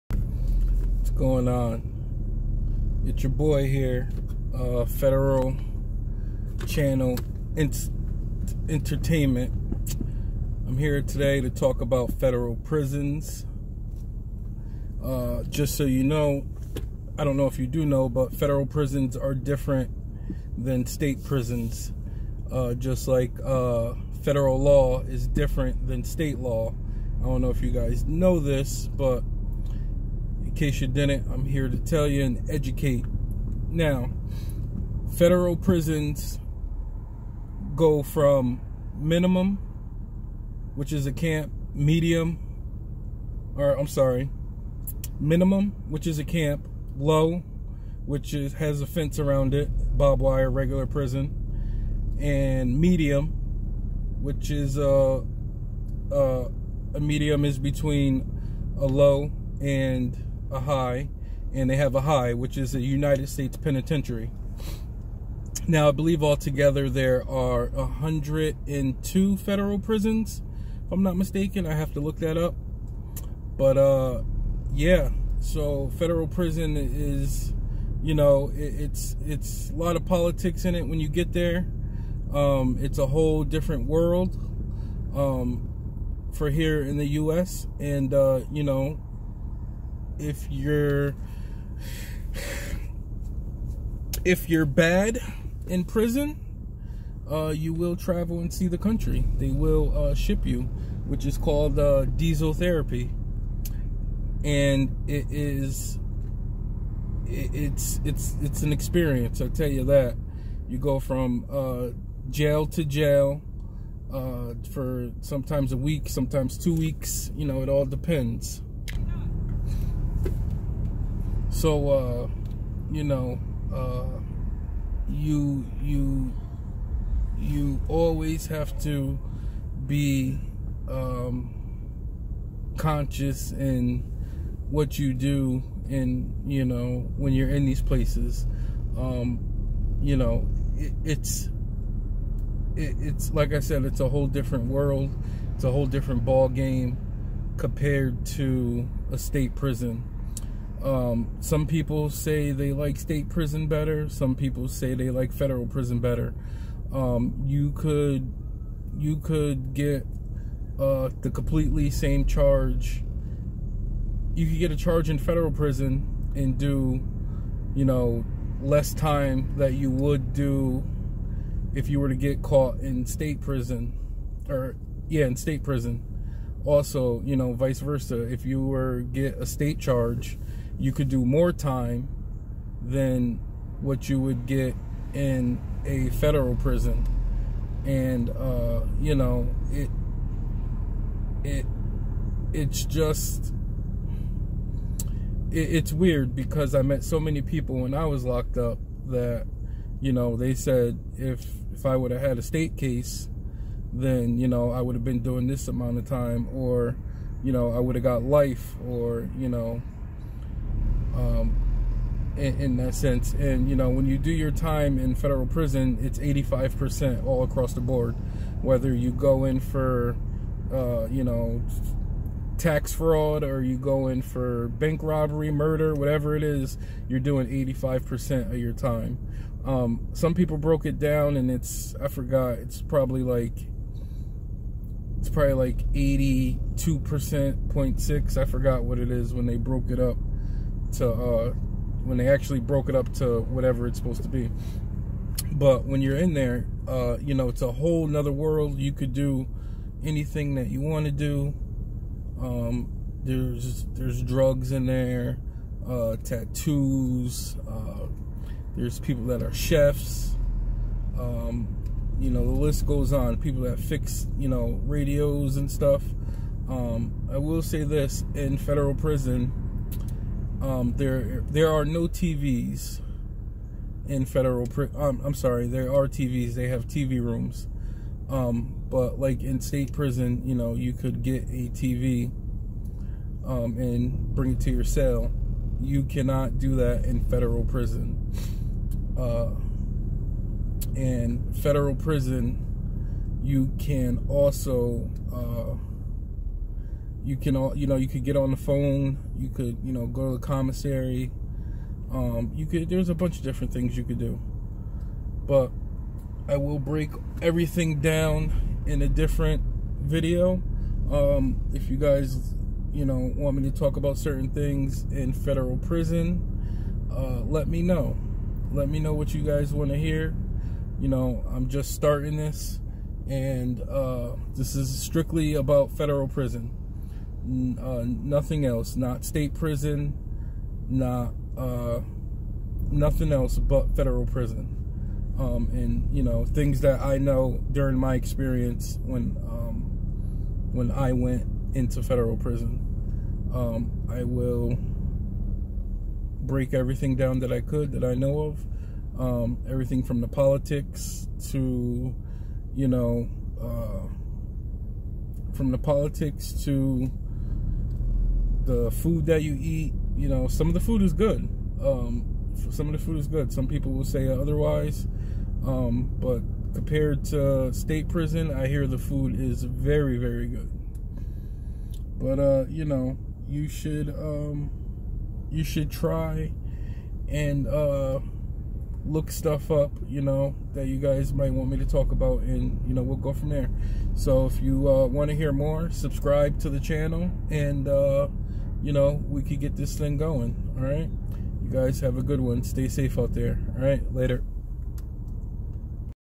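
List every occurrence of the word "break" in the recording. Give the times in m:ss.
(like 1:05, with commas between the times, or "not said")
5:06, 5:44.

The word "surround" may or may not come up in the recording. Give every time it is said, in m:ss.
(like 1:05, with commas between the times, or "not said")
not said.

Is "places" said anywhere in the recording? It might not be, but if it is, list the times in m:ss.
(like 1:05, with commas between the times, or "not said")
2:17.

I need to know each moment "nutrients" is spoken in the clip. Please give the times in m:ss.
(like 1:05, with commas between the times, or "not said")
not said.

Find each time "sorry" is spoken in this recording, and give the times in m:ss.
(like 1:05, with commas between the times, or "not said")
0:43, 4:35.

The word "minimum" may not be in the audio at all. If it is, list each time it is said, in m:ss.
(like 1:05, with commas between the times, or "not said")
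0:38, 0:45.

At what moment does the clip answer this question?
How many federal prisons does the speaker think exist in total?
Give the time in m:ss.
1:07.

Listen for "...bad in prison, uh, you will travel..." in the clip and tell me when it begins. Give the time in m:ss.
1:34.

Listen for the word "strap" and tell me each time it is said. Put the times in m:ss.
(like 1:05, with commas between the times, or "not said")
not said.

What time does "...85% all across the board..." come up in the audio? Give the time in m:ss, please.
3:36.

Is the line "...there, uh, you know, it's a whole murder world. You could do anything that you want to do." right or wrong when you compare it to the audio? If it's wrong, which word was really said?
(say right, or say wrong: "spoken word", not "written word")
wrong: "nother", not "murder".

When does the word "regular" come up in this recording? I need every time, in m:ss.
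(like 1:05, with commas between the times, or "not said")
0:50.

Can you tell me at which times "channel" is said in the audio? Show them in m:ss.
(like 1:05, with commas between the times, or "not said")
0:06, 6:26.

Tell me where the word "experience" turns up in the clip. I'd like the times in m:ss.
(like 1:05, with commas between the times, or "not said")
1:48, 5:38.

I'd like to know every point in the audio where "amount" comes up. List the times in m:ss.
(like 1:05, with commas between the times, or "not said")
3:25.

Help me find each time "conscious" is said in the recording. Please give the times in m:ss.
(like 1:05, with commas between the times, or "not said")
2:12.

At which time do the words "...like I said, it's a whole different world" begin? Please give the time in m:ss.
2:23.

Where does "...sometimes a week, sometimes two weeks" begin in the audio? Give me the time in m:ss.
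1:55.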